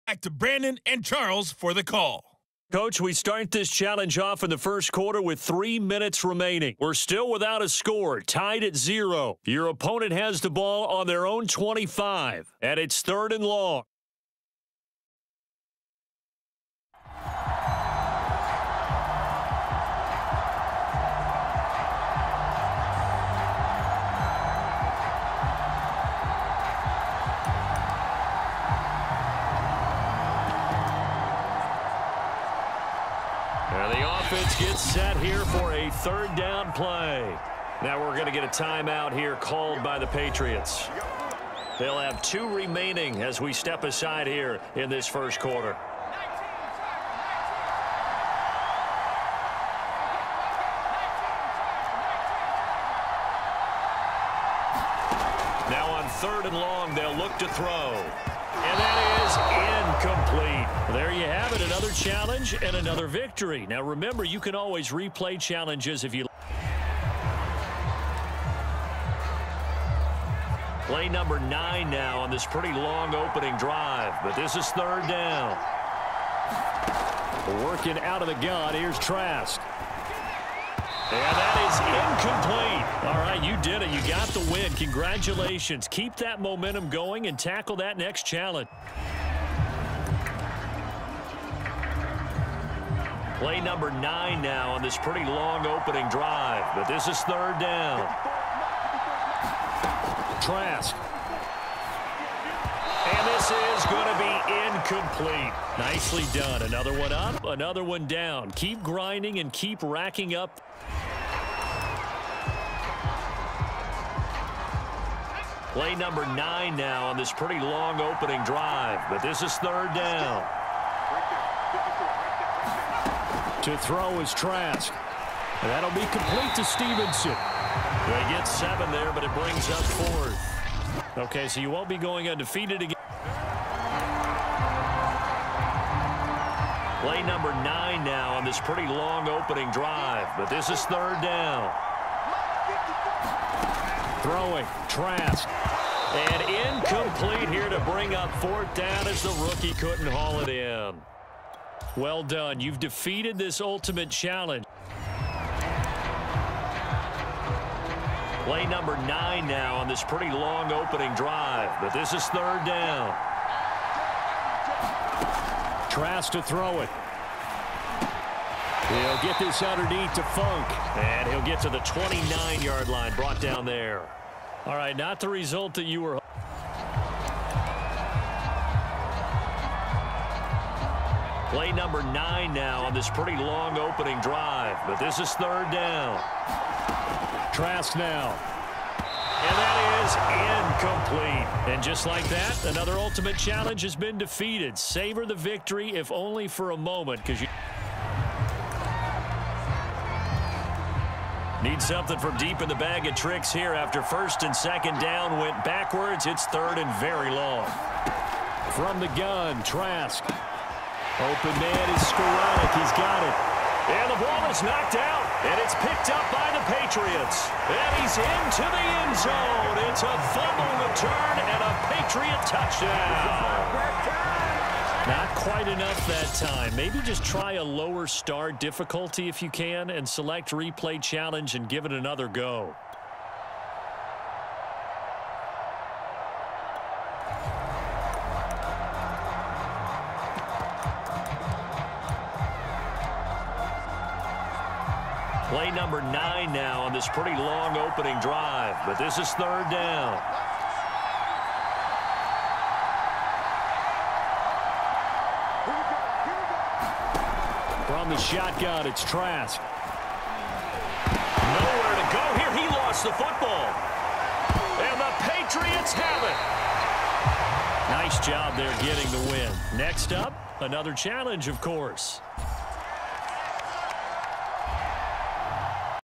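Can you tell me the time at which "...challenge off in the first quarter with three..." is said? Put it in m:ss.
0:03.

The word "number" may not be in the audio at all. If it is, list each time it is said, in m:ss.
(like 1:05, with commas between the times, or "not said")
1:11, 1:33, 1:55, 2:17, 2:38, 3:01, 4:05.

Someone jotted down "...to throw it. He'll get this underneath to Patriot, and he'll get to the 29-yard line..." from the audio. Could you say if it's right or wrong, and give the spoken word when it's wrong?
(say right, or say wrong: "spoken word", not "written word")
wrong: "Funk", not "Patriot".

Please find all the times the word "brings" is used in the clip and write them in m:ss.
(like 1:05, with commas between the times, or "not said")
2:09, 2:27.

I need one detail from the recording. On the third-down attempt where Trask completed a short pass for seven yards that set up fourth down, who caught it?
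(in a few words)
Stevenson.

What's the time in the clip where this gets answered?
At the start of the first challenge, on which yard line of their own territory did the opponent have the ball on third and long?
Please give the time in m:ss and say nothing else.
0:11.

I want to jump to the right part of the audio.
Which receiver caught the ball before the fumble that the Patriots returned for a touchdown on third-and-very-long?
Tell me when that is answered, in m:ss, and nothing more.
3:32.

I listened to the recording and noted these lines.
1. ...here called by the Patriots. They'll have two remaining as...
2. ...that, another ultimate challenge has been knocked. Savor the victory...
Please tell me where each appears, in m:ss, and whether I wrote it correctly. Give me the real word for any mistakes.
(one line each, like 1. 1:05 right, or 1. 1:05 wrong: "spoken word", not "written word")
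1. 0:39 right
2. 3:12 wrong: "defeated", not "knocked".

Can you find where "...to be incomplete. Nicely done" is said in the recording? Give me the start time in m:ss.
1:44.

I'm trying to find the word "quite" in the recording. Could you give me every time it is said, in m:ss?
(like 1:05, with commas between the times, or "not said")
3:45.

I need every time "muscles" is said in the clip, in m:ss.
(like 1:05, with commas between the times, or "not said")
not said.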